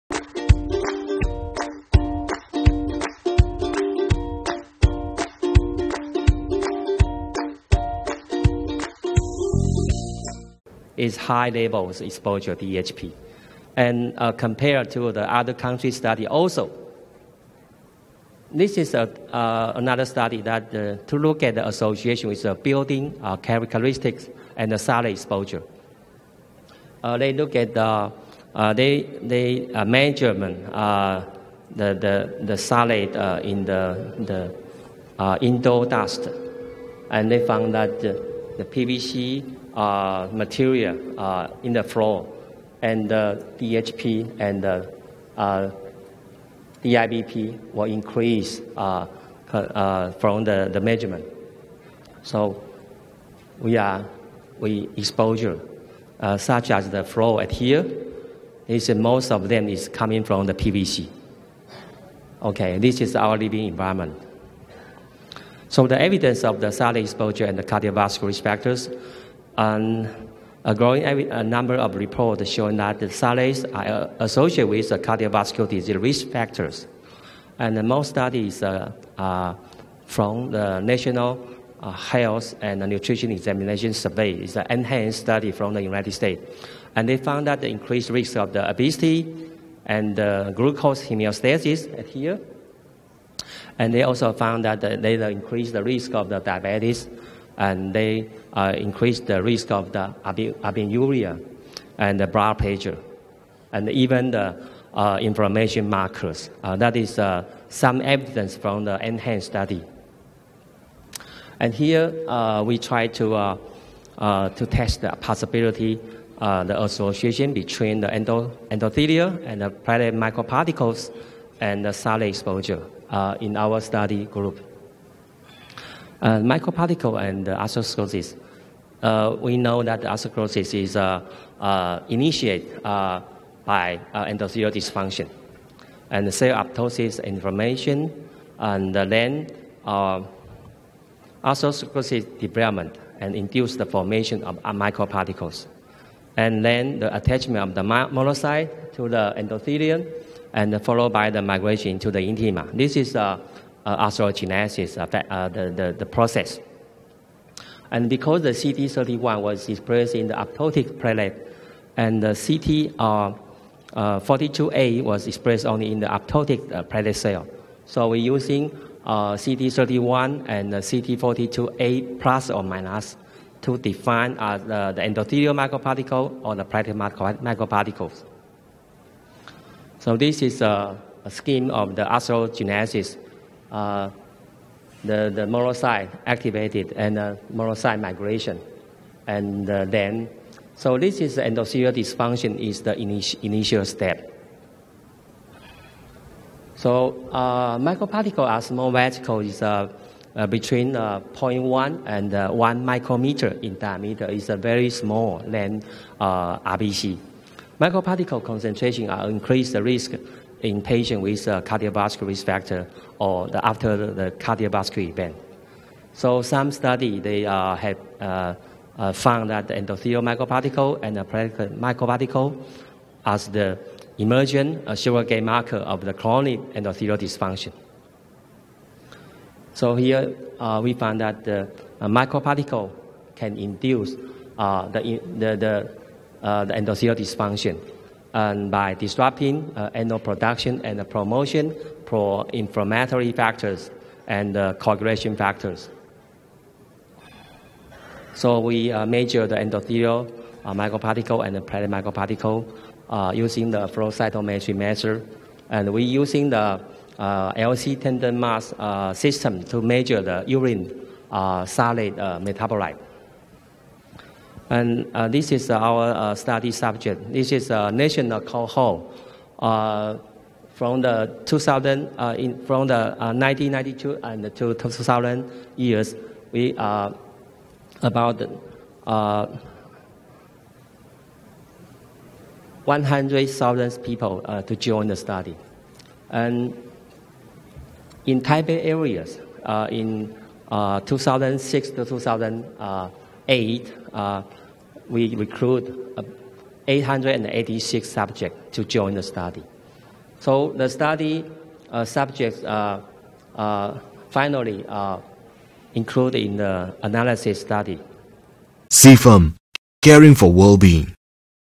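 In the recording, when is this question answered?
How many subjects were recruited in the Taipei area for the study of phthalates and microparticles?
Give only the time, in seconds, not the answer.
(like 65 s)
296 s.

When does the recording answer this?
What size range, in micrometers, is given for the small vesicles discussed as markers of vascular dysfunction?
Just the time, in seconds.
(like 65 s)
201 s.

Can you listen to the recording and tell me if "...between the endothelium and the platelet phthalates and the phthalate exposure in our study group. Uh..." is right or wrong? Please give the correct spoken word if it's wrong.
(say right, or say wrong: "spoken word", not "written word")
wrong: "microparticles", not "phthalates".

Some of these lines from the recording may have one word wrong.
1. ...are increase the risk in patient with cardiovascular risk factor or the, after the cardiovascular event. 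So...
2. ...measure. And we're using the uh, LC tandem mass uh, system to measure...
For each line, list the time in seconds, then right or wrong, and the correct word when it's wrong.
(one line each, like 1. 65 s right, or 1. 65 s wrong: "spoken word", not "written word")
1. 209 s right
2. 254 s right.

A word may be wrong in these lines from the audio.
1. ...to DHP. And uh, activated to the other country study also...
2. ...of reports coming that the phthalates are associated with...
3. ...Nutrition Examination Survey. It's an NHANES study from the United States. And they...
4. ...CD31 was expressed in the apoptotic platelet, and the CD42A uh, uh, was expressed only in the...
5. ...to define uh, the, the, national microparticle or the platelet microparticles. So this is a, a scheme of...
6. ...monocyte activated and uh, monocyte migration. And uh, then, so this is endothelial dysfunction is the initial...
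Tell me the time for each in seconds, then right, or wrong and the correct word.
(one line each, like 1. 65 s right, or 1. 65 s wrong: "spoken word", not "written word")
1. 12 s wrong: "compared", not "activated"
2. 71 s wrong: "showing", not "coming"
3. 82 s right
4. 158 s right
5. 173 s wrong: "endothelial", not "national"
6. 185 s right.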